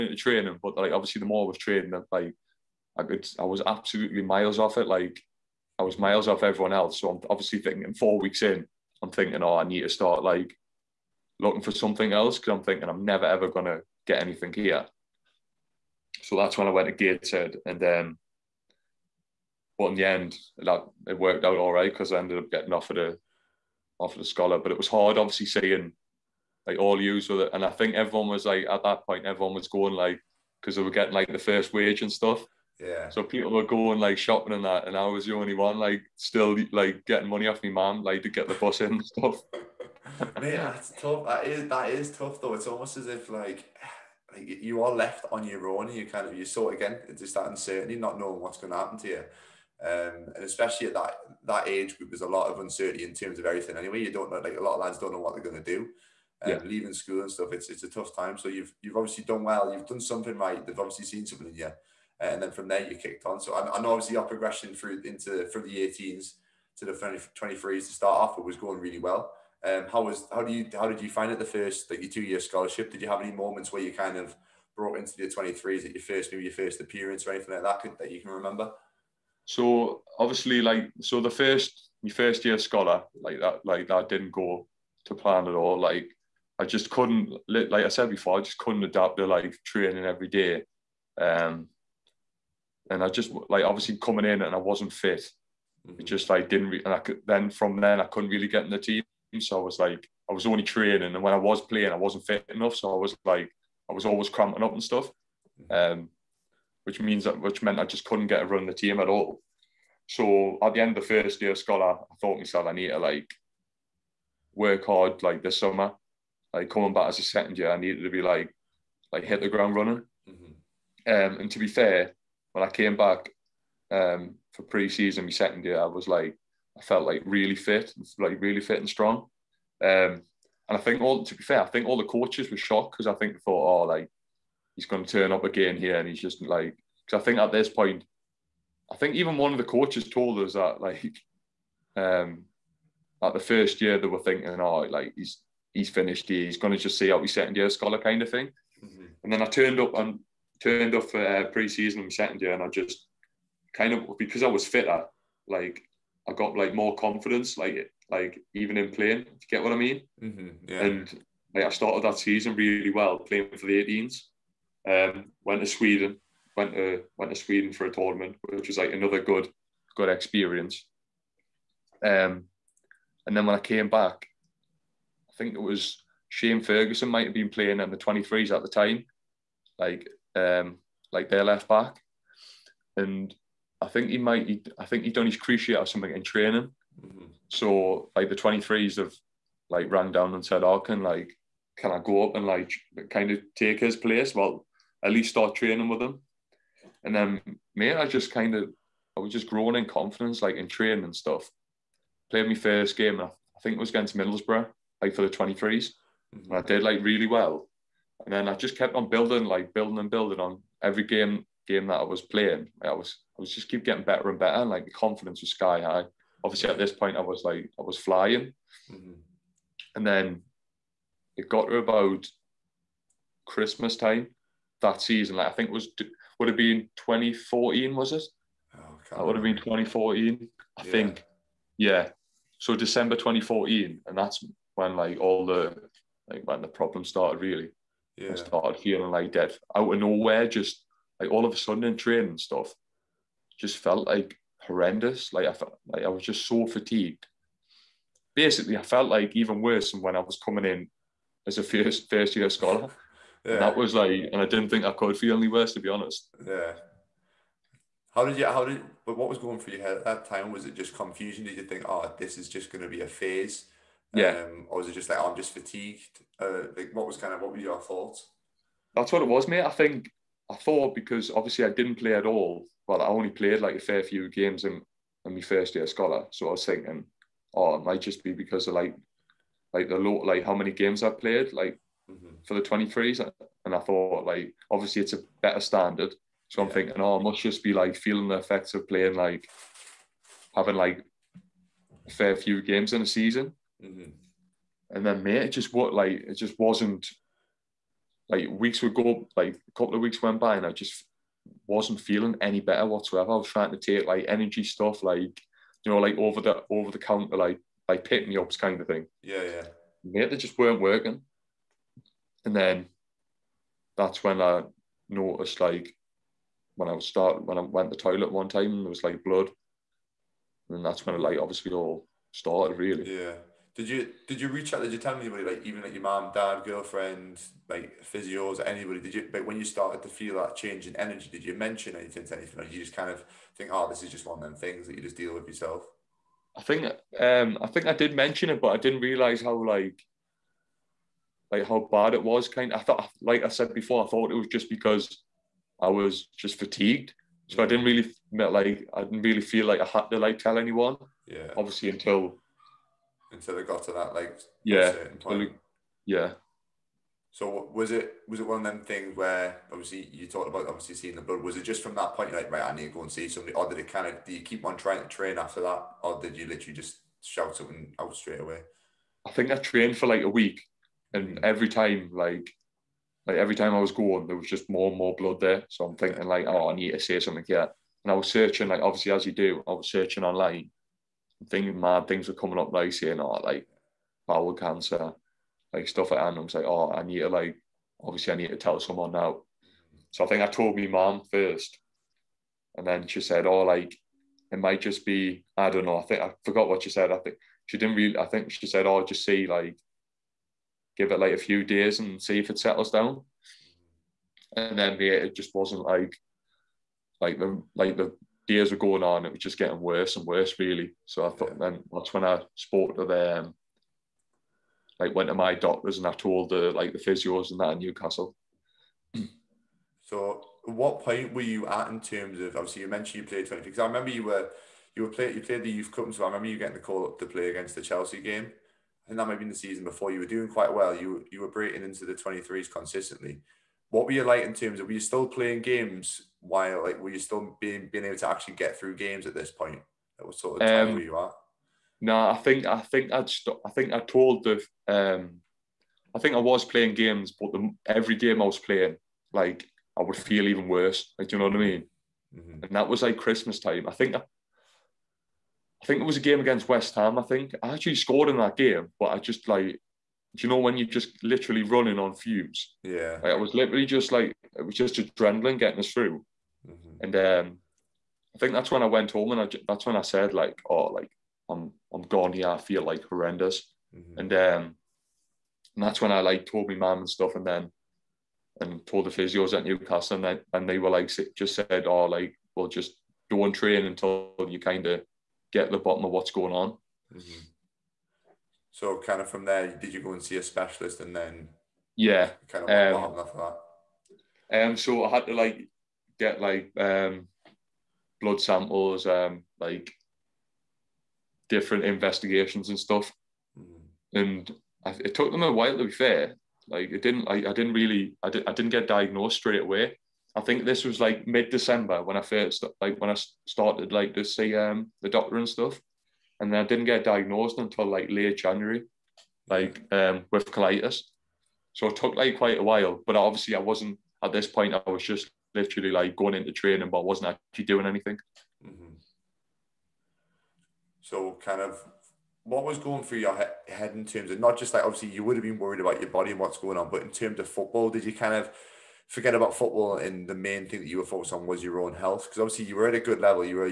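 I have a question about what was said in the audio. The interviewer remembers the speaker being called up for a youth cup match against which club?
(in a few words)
Chelsea.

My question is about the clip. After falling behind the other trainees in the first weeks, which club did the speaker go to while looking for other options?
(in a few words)
Gateshead.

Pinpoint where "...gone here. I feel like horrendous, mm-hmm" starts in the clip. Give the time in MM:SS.
07:52.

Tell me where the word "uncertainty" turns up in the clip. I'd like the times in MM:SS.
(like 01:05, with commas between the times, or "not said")
00:47, 00:52.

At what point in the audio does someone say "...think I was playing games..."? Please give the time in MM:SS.
07:26.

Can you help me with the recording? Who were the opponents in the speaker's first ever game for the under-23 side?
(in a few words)
Middlesbrough.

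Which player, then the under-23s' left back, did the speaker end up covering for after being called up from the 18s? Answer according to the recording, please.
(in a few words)
Shane Ferguson.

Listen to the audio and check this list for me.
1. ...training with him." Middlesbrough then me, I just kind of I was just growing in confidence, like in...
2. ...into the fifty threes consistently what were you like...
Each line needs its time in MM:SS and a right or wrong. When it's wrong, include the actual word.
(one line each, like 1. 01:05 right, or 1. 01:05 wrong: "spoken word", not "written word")
1. 03:15 wrong: "And", not "Middlesbrough"
2. 07:11 wrong: "twenty", not "fifty".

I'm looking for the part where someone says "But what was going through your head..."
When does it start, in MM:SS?
04:19.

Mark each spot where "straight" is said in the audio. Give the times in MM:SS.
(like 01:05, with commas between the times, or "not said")
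06:08, 08:29.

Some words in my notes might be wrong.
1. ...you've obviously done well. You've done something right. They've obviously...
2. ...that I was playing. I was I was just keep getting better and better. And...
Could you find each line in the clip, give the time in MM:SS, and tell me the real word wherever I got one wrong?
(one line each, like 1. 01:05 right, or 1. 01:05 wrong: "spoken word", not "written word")
1. 00:58 right
2. 03:31 right.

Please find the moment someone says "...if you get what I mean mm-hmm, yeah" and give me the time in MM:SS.
02:39.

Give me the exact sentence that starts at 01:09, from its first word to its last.
Um, how was how do you how did you find it the first like your two year scholarship?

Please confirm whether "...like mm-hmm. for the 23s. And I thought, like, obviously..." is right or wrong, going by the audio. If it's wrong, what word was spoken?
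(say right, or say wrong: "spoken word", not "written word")
right.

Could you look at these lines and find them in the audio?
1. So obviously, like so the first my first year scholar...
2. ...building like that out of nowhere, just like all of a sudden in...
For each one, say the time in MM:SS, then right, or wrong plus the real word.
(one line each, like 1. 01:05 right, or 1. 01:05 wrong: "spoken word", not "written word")
1. 01:19 right
2. 03:58 wrong: "feeling", not "building".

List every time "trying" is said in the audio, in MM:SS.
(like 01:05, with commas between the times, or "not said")
05:03, 06:04.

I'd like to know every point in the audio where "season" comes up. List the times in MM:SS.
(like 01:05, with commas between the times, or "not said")
02:04, 02:31, 02:42, 03:45, 04:53, 07:09.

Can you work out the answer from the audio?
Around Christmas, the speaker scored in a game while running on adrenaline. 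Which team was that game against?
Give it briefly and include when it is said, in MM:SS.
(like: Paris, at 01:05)
West Ham, at 07:36.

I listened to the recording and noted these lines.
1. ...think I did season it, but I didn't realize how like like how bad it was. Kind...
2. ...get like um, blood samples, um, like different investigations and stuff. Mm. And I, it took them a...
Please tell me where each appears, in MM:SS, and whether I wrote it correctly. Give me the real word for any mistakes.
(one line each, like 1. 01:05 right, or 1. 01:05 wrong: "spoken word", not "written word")
1. 05:37 wrong: "mention", not "season"
2. 08:16 right.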